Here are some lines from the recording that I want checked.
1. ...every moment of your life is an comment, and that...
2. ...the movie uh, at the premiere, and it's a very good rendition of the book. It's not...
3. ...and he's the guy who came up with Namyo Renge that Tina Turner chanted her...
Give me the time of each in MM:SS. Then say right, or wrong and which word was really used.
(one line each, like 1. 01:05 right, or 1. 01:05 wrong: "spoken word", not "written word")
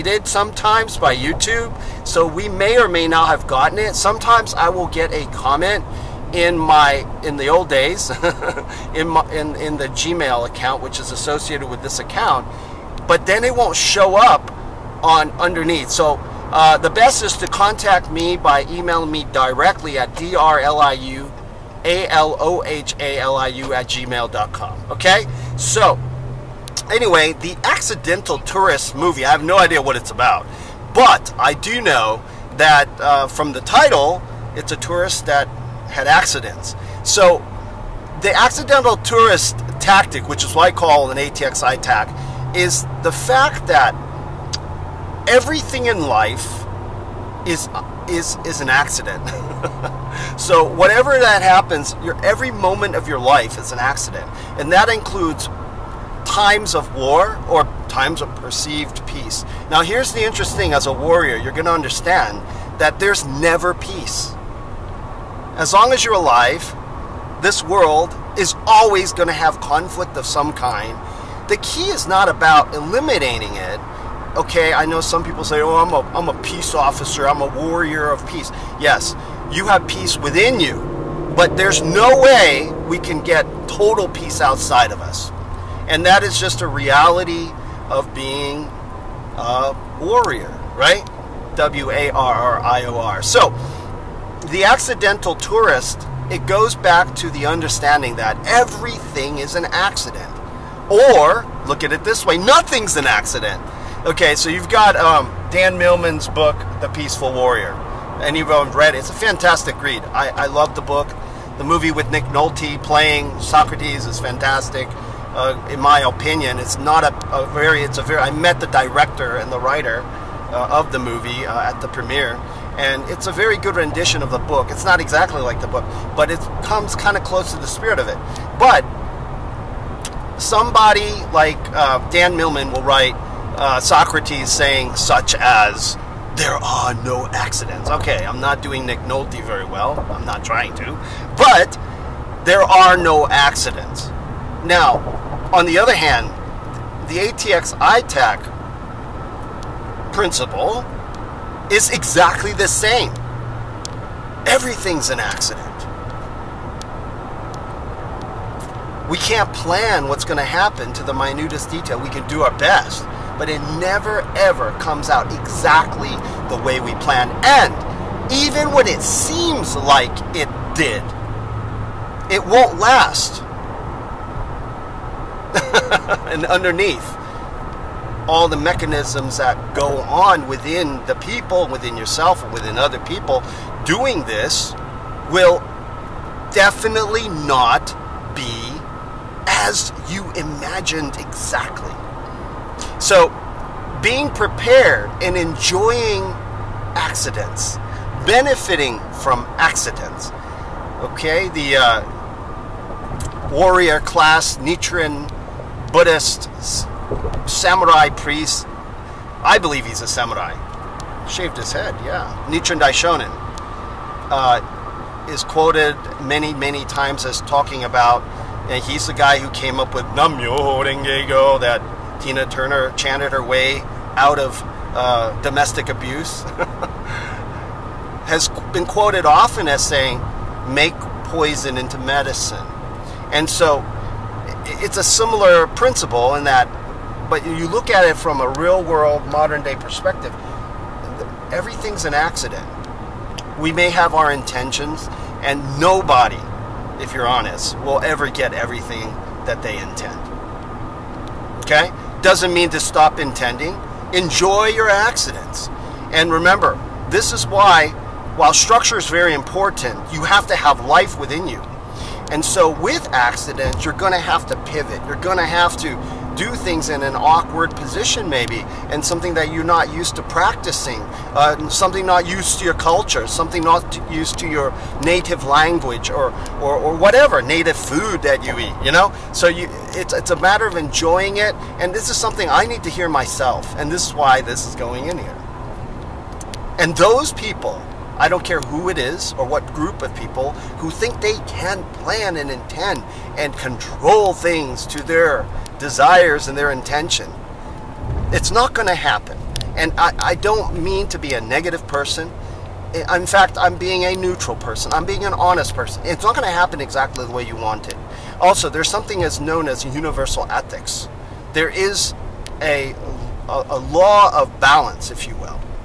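1. 00:52 wrong: "accident", not "comment"
2. 02:00 right
3. 03:38 right.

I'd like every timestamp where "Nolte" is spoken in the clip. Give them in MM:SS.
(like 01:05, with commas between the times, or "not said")
01:52, 02:18.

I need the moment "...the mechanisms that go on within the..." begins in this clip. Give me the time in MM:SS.
02:58.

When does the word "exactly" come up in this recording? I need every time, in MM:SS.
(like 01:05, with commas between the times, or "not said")
02:04, 02:31, 02:45, 03:11, 05:06.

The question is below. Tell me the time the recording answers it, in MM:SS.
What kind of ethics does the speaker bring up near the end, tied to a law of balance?
05:09.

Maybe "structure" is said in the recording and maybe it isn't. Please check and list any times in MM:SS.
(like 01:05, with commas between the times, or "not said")
04:18.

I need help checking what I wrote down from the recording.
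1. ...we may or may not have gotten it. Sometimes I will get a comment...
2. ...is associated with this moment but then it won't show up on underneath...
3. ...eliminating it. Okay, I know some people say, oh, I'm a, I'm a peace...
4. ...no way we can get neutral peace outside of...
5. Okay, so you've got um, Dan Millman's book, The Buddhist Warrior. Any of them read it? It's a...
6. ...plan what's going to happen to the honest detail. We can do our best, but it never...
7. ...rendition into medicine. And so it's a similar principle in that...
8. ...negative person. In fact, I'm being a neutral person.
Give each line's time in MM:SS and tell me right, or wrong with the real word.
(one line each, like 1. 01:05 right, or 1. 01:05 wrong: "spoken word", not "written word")
1. 00:02 right
2. 00:10 wrong: "account", not "moment"
3. 01:12 right
4. 01:21 wrong: "total", not "neutral"
5. 01:44 wrong: "Peaceful", not "Buddhist"
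6. 02:39 wrong: "minutest", not "honest"
7. 03:51 wrong: "poison", not "rendition"
8. 05:01 right.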